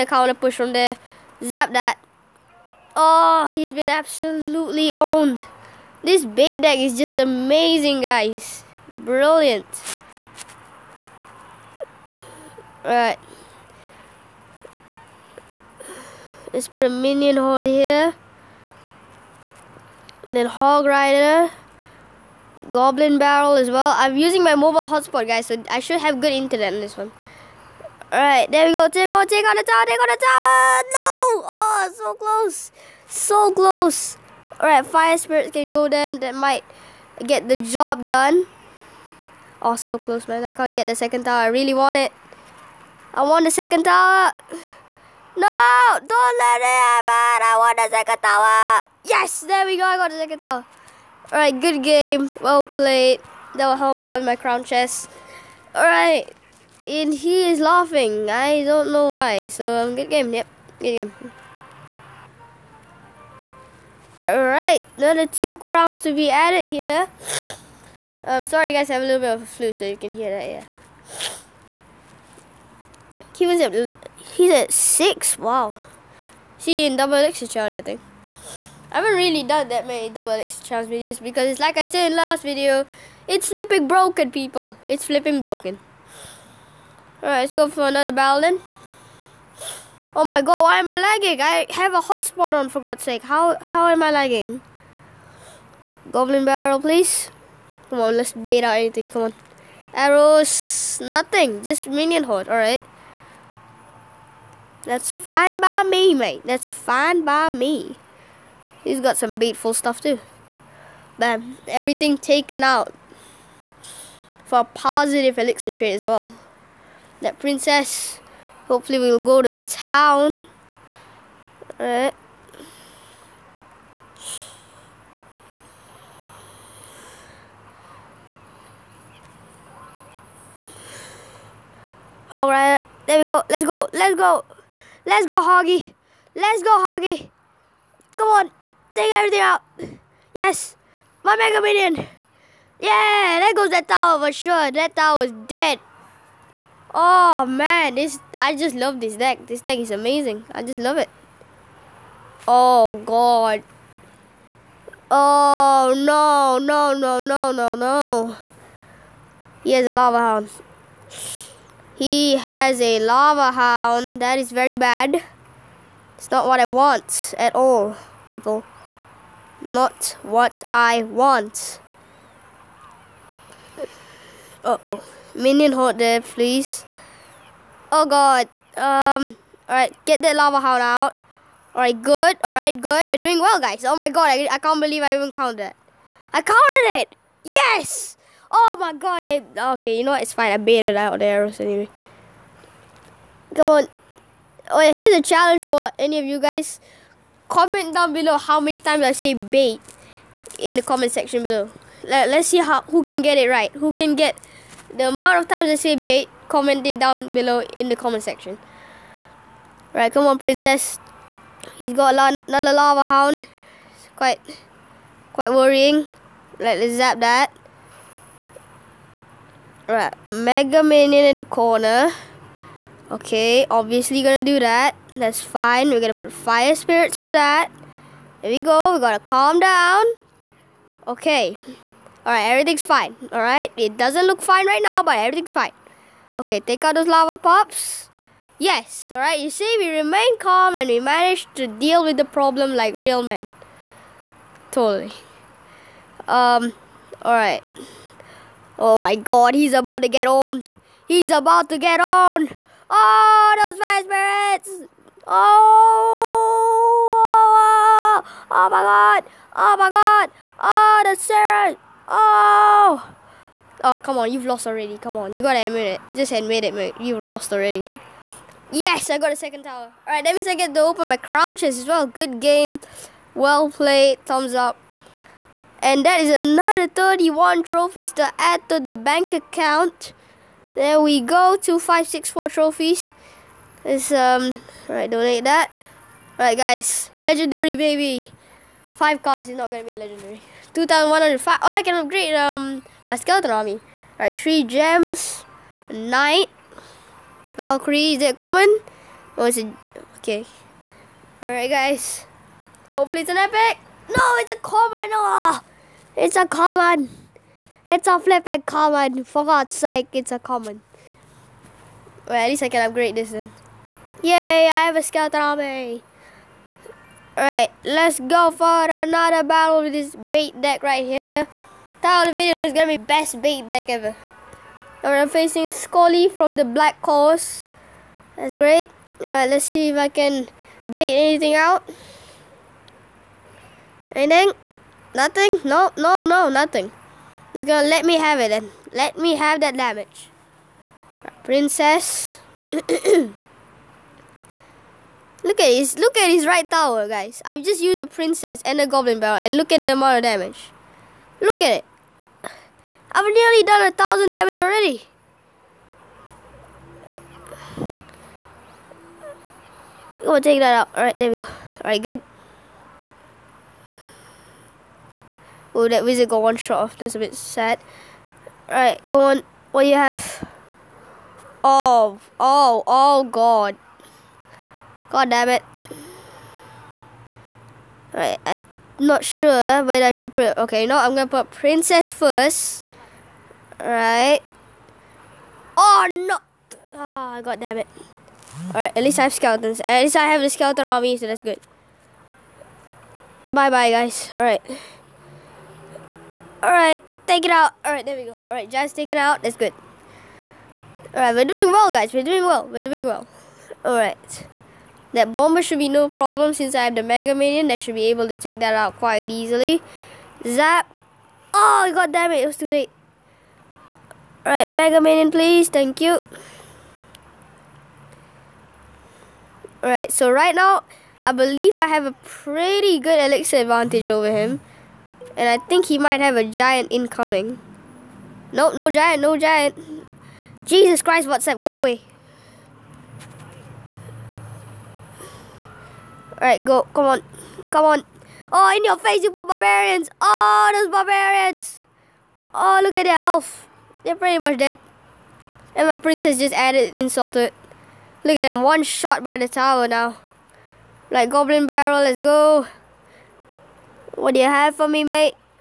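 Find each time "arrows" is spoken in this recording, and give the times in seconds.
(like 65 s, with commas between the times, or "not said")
99 s, 191 s.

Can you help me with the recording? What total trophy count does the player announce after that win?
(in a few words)
2564.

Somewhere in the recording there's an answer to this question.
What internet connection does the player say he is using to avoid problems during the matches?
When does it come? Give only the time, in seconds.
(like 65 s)
24 s.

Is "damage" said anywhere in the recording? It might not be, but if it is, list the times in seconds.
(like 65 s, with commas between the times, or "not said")
339 s, 350 s, 354 s.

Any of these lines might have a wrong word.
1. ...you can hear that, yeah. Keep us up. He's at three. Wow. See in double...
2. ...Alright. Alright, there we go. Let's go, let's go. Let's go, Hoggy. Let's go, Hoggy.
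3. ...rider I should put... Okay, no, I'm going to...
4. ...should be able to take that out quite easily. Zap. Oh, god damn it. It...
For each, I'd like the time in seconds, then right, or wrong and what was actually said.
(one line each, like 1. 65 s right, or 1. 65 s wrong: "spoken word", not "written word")
1. 69 s wrong: "six", not "three"
2. 132 s right
3. 379 s wrong: "whether", not "rider"
4. 407 s right.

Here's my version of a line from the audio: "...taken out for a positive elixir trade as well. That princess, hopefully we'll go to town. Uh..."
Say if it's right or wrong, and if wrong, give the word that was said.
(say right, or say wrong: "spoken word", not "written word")
right.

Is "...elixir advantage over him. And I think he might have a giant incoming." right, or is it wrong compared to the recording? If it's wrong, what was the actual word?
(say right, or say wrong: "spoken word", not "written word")
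right.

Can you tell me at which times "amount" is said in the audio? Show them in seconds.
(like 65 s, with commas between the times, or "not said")
205 s, 349 s.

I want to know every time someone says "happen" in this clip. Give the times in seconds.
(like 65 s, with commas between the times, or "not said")
46 s.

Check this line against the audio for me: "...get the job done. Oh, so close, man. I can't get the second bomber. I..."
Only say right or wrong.
wrong.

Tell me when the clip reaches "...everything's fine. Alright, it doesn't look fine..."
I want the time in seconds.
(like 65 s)
232 s.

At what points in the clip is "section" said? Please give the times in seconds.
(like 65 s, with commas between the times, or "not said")
201 s, 208 s.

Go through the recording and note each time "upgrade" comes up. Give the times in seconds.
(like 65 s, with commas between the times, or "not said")
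292 s, 312 s.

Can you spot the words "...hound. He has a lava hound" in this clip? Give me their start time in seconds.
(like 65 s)
160 s.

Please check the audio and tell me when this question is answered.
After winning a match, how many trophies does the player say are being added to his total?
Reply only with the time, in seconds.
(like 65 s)
276 s.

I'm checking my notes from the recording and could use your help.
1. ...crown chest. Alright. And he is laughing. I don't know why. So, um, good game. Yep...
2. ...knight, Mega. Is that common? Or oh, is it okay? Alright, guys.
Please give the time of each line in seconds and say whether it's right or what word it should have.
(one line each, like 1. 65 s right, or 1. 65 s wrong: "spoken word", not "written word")
1. 54 s right
2. 295 s wrong: "Valkyrie", not "Mega".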